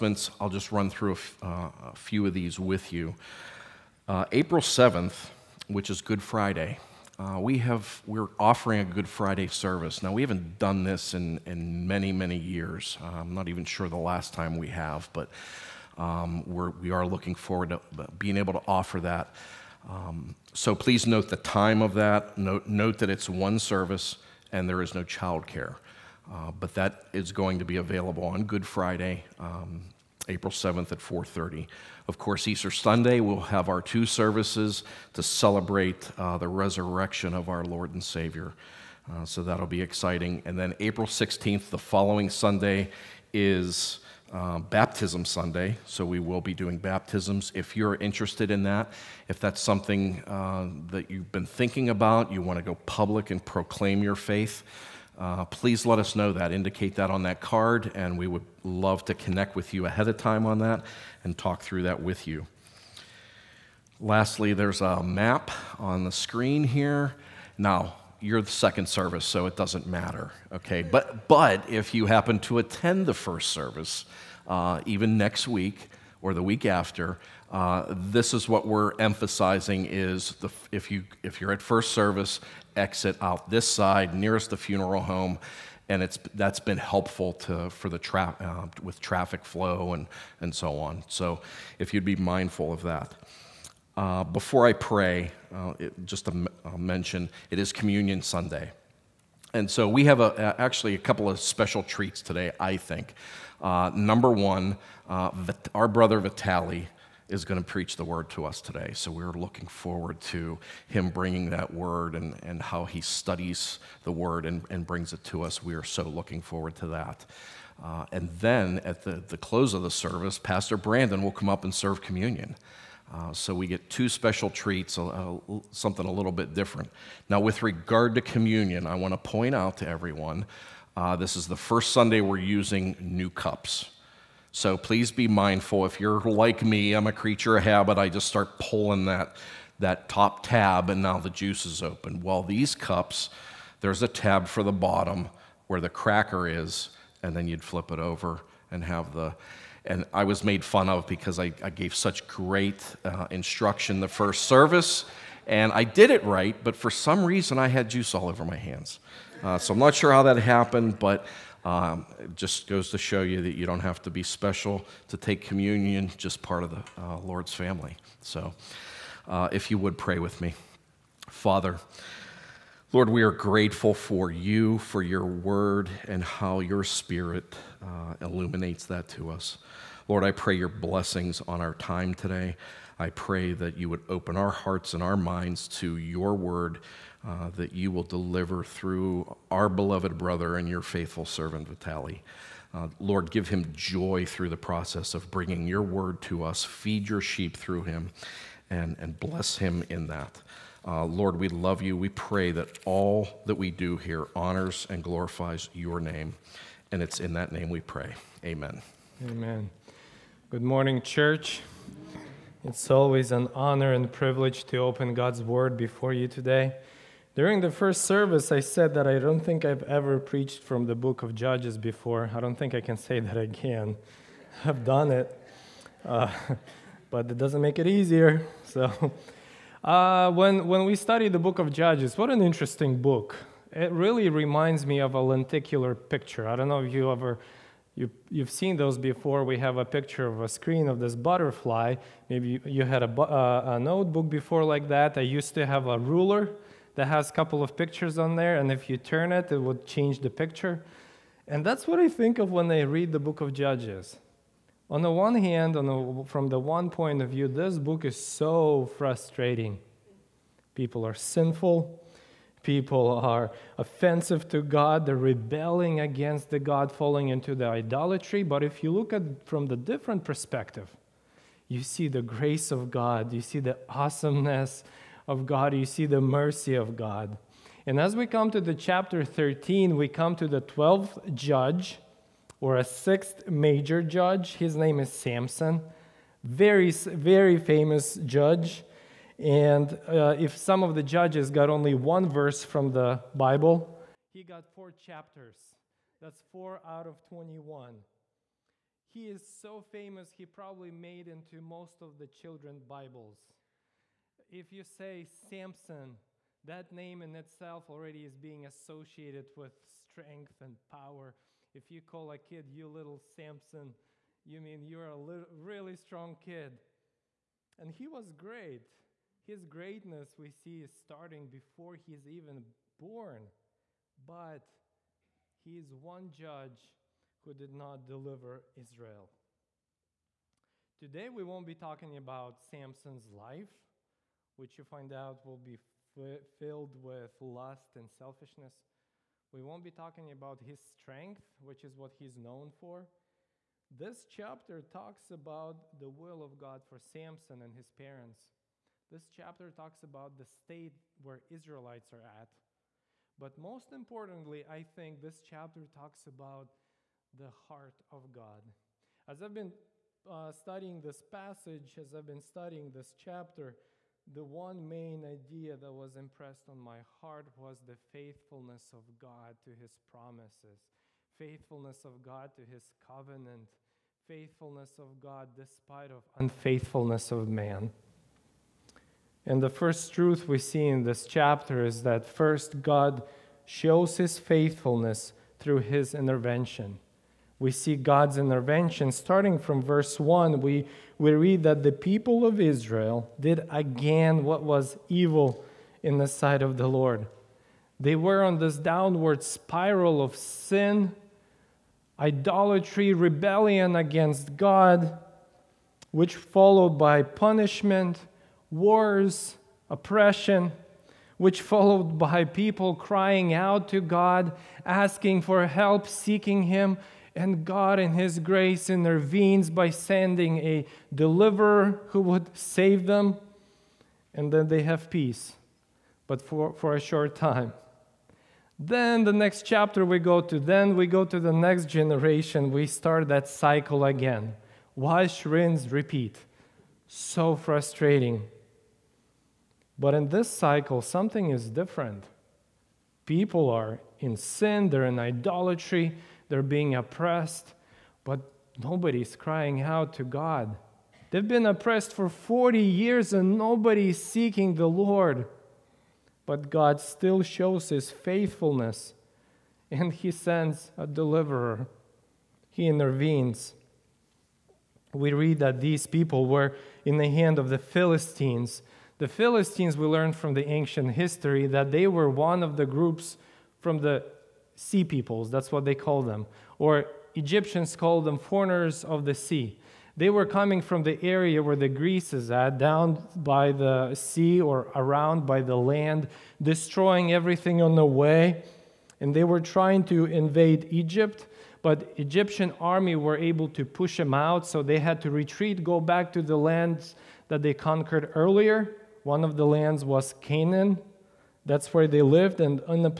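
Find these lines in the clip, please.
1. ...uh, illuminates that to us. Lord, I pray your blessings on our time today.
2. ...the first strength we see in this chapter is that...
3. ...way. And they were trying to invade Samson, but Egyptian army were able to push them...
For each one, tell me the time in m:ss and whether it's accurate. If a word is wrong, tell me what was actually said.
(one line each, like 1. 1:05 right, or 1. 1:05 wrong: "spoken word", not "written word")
1. 2:57 right
2. 6:19 wrong: "truth", not "strength"
3. 8:08 wrong: "Egypt", not "Samson".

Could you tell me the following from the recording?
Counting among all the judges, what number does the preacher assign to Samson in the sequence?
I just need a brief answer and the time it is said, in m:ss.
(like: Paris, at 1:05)
12th, at 4:40.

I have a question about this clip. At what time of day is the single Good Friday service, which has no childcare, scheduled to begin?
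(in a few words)
4:30.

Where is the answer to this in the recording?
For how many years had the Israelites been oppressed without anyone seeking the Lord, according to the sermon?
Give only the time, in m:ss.
7:32.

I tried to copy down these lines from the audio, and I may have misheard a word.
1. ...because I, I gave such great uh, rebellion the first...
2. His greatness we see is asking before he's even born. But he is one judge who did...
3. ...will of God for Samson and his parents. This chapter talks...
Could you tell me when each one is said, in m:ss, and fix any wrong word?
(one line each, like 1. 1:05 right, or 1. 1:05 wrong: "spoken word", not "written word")
1. 2:31 wrong: "instruction", not "rebellion"
2. 5:19 wrong: "starting", not "asking"
3. 5:46 right.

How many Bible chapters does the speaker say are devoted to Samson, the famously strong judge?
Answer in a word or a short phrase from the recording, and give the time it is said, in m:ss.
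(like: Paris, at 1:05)
4, at 4:54.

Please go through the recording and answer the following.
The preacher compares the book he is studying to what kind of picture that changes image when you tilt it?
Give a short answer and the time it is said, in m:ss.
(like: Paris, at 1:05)
lenticular picture, at 3:55.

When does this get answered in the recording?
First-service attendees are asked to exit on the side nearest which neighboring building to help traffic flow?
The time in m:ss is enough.
1:24.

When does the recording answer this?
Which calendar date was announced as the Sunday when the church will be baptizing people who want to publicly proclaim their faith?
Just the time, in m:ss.
0:40.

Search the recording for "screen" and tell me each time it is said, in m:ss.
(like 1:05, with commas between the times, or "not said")
1:06, 4:00.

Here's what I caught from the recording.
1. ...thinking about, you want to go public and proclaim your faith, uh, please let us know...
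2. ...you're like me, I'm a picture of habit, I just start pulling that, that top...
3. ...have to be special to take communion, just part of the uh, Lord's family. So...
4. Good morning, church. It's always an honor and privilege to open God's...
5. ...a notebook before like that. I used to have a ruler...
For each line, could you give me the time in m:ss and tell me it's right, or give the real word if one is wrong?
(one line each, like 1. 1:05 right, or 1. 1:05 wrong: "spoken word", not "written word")
1. 0:51 right
2. 2:16 wrong: "creature", not "picture"
3. 2:43 right
4. 3:30 right
5. 4:03 right.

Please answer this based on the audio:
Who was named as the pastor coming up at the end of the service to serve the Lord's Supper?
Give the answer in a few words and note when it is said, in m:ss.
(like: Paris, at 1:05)
Pastor Brandon, at 2:00.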